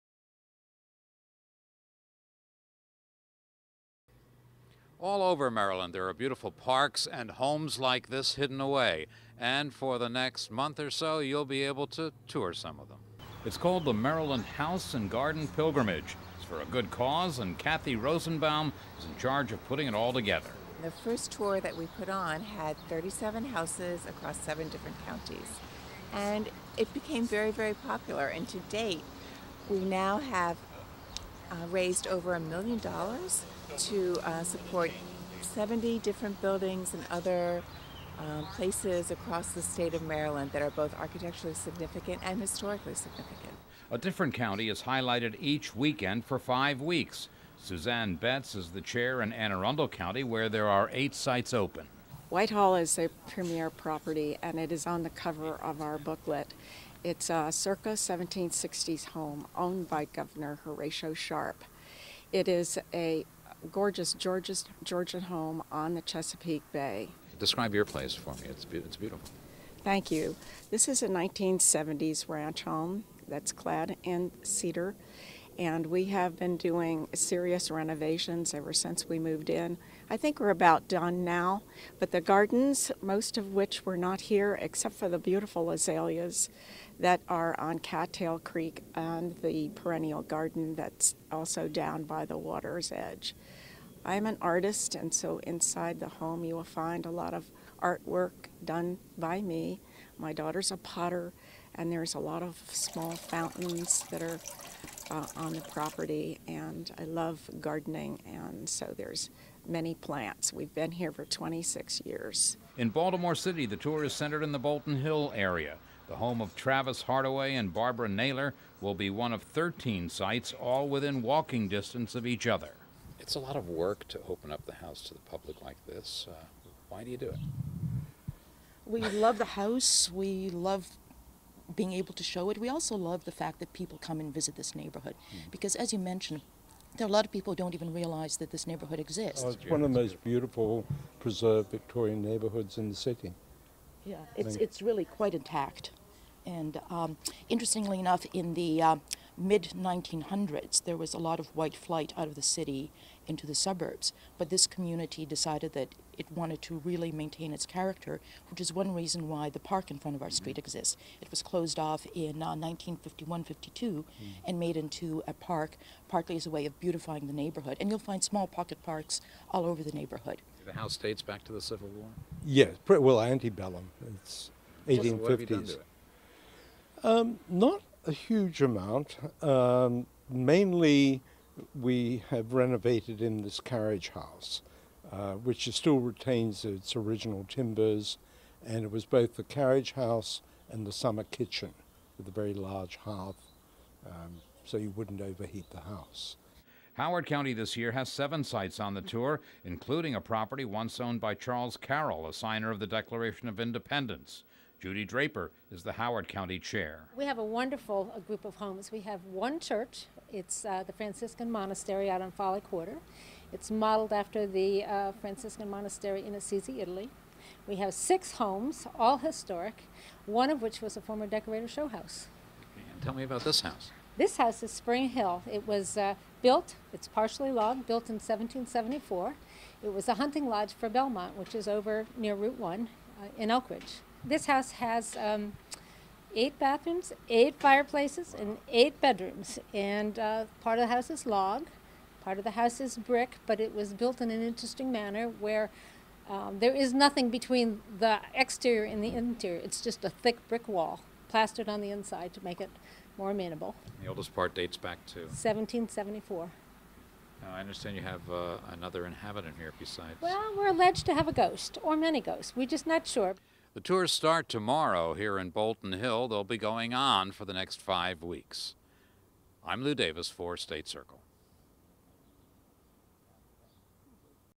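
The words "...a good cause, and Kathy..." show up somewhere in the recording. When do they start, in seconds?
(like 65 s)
16 s.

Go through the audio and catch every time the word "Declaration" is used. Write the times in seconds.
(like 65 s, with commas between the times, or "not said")
202 s.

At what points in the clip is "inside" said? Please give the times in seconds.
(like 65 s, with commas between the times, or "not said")
95 s, 251 s.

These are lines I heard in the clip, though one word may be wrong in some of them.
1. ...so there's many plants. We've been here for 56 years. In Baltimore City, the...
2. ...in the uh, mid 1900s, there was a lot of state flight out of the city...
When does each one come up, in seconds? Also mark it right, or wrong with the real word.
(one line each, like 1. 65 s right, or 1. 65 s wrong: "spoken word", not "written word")
1. 108 s wrong: "26", not "56"
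2. 148 s wrong: "white", not "state".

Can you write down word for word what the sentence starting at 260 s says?
Well, we're alleged to have a ghost or many ghosts.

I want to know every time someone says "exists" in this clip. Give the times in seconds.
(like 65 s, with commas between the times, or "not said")
138 s, 160 s.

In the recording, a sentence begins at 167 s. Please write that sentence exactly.
And you'll find small pocket parks all over the neighborhood.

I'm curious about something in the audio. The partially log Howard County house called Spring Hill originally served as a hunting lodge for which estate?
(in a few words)
Belmont.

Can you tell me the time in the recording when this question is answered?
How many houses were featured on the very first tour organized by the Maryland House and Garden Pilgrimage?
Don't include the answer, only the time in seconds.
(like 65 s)
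22 s.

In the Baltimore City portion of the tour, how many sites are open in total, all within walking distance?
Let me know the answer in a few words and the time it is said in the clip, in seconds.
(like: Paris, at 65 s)
13, at 119 s.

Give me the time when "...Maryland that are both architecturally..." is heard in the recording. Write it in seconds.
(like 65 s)
40 s.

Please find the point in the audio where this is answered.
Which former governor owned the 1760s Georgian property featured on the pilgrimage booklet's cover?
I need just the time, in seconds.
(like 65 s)
60 s.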